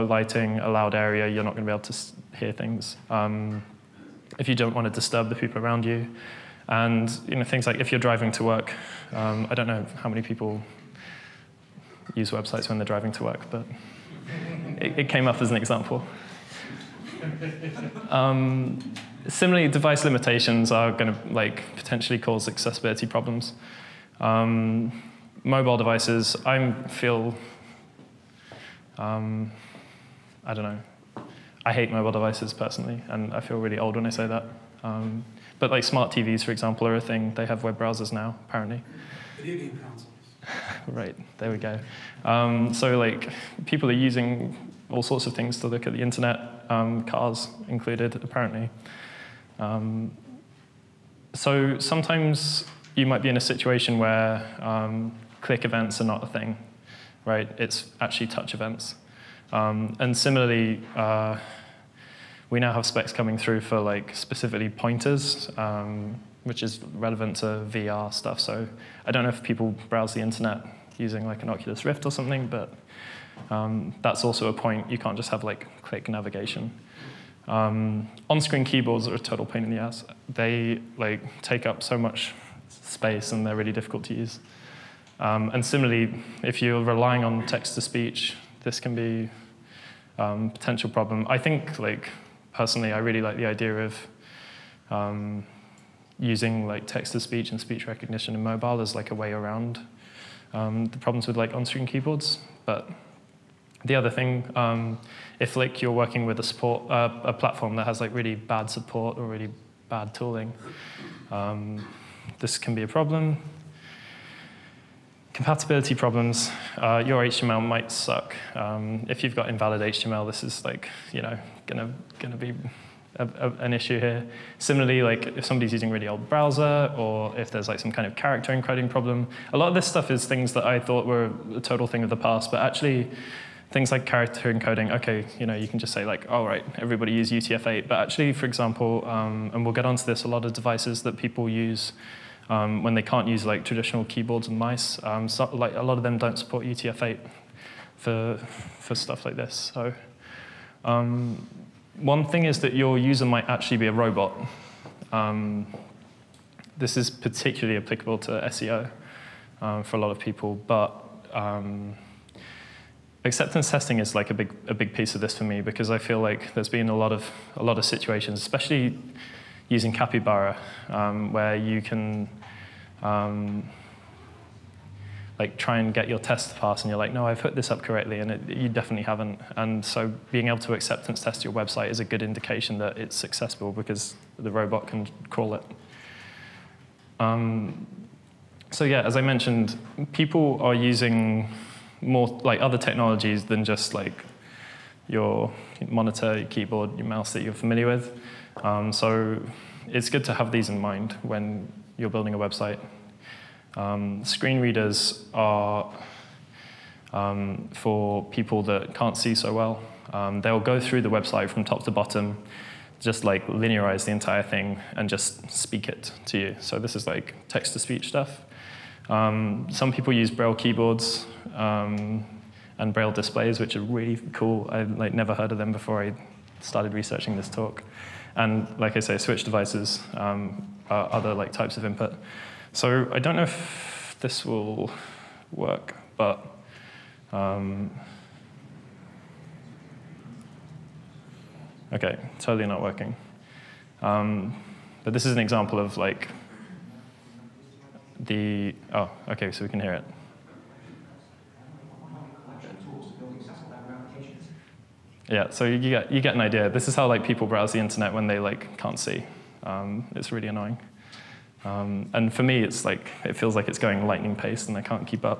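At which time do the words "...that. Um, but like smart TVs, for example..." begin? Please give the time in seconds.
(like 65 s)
34 s.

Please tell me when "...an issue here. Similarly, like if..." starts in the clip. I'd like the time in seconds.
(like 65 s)
123 s.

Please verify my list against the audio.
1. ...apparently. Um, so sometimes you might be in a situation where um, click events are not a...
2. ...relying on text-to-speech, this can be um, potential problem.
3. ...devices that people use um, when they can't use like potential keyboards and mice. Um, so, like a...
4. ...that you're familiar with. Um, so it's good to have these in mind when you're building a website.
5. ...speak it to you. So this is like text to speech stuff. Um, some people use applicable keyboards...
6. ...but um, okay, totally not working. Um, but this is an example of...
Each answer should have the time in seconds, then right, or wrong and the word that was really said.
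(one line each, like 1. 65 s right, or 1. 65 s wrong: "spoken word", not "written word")
1. 48 s right
2. 86 s right
3. 140 s wrong: "traditional", not "potential"
4. 197 s right
5. 215 s wrong: "braille", not "applicable"
6. 236 s right.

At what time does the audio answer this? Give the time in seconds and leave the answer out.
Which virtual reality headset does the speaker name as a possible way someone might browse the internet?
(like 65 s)
71 s.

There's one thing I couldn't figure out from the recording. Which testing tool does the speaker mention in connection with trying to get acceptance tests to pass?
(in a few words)
Capybara.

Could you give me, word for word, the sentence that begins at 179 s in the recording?
And so being able to acceptance test your website is a good indication that it's successful because the robot can crawl it.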